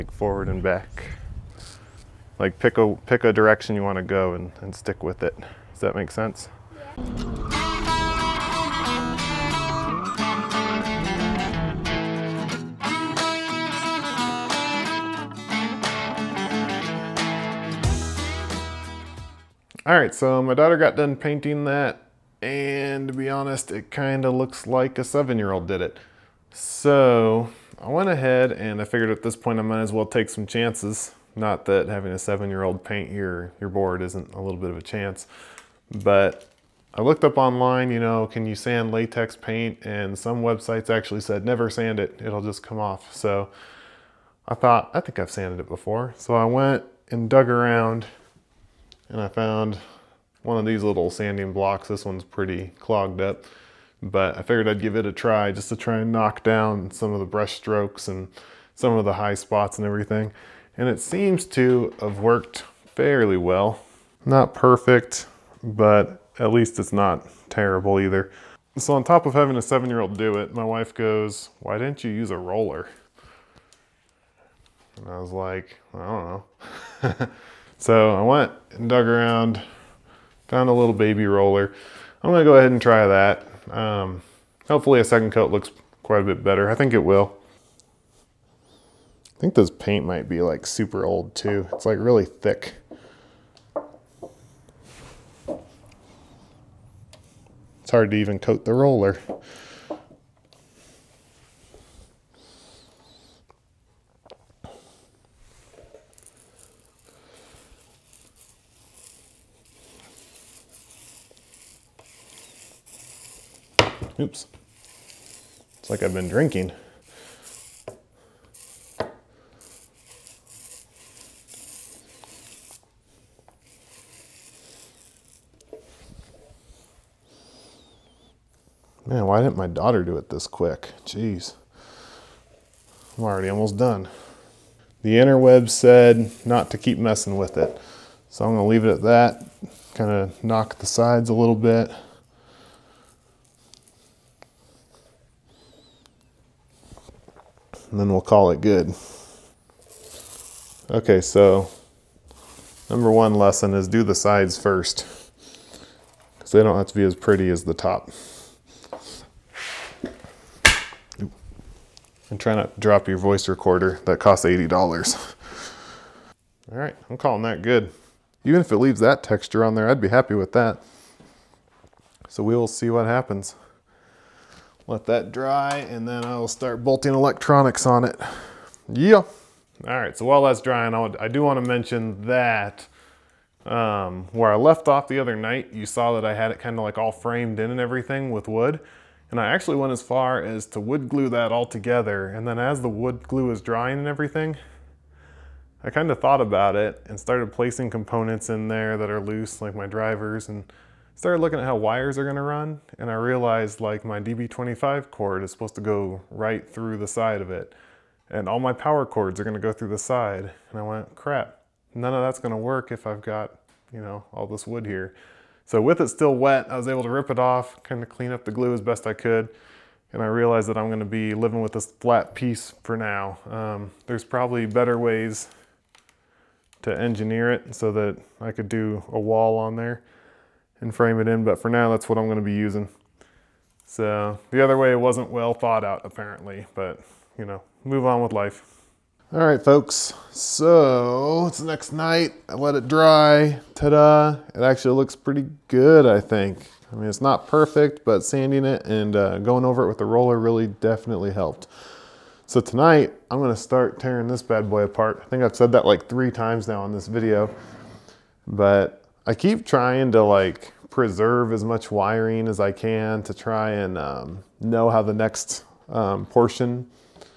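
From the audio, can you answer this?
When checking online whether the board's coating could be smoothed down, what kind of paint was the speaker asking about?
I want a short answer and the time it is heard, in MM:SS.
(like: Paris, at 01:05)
latex, at 00:38.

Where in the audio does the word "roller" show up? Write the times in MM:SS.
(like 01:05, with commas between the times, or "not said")
01:12, 01:21, 01:38, 04:10.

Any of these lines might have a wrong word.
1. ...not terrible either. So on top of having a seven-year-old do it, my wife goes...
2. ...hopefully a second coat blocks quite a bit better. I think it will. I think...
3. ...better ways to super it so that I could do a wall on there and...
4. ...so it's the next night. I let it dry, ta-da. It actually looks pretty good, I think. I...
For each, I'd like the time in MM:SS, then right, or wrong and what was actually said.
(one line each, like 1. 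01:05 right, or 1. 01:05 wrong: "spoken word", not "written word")
1. 01:06 right
2. 01:24 wrong: "looks", not "blocks"
3. 03:44 wrong: "engineer", not "super"
4. 04:00 right.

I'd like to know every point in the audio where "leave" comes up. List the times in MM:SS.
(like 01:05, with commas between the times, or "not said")
02:18, 02:48.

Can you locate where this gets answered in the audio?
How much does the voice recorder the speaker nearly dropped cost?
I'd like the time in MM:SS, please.
02:44.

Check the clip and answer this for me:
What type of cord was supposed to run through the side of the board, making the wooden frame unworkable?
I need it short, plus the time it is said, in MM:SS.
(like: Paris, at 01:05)
DB25, at 03:24.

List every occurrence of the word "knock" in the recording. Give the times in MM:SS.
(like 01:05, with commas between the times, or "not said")
00:56, 02:20.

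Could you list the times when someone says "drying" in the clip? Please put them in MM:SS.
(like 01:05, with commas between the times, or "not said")
03:00, 03:13.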